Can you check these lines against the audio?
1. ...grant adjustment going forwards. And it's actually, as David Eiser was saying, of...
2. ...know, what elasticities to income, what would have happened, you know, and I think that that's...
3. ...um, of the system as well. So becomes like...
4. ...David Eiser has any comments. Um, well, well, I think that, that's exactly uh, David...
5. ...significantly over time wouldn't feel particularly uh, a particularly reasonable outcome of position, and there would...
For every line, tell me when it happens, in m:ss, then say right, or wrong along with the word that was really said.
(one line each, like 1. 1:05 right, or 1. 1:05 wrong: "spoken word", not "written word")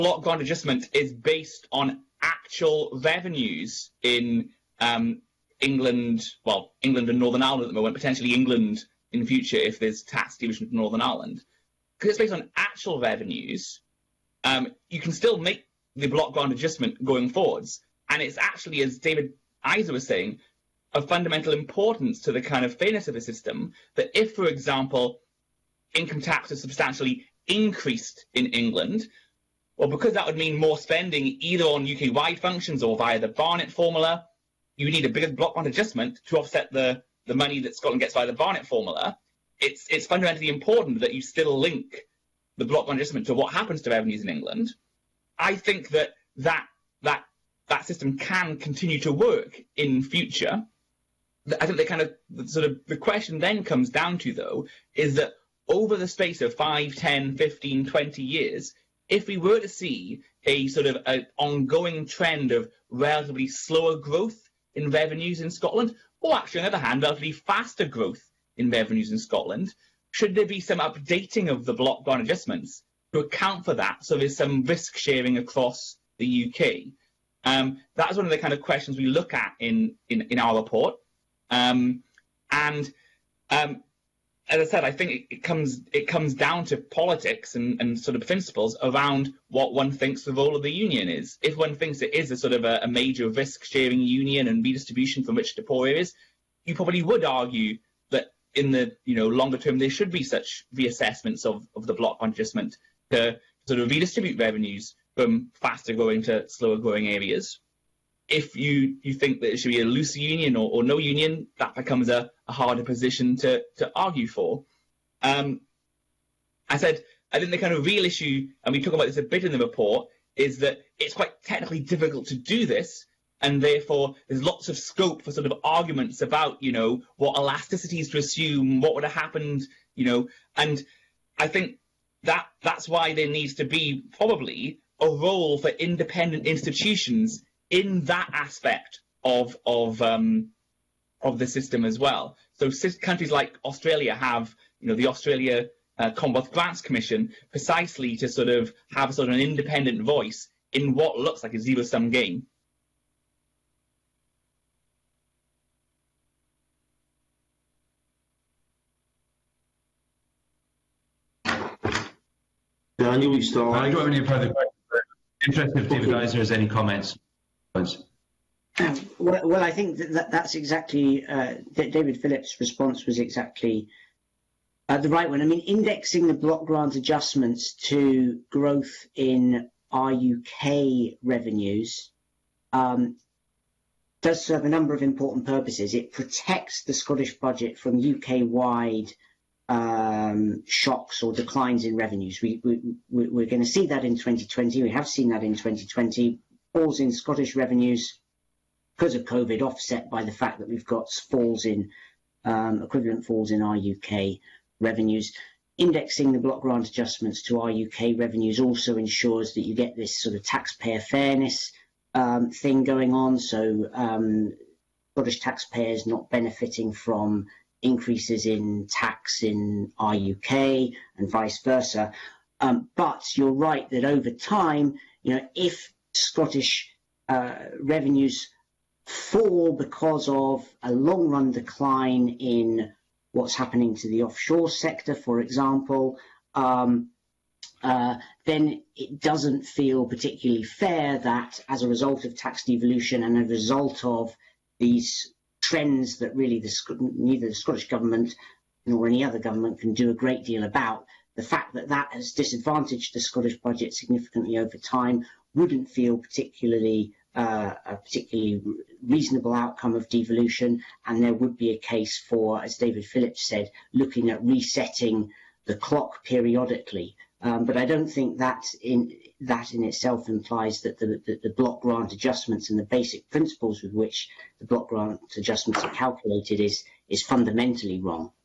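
1. 0:16 right
2. 2:06 wrong: "assume", not "income"
3. 2:20 wrong: "countries", not "becomes"
4. 2:45 right
5. 4:13 wrong: "devolution", not "position".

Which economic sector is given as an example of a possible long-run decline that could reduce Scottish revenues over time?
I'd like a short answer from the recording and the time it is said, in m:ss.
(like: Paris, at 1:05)
offshore sector, at 3:54.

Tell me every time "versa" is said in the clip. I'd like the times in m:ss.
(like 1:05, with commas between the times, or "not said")
3:41.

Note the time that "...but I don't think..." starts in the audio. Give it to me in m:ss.
4:27.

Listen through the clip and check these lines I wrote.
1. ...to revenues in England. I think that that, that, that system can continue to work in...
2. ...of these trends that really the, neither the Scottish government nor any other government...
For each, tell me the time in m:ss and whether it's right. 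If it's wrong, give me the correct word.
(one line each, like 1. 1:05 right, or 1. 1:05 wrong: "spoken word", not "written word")
1. 0:43 right
2. 4:04 right.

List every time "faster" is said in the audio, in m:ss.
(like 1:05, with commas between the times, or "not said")
1:07, 1:45.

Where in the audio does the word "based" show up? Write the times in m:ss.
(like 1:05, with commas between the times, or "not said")
0:01, 0:12.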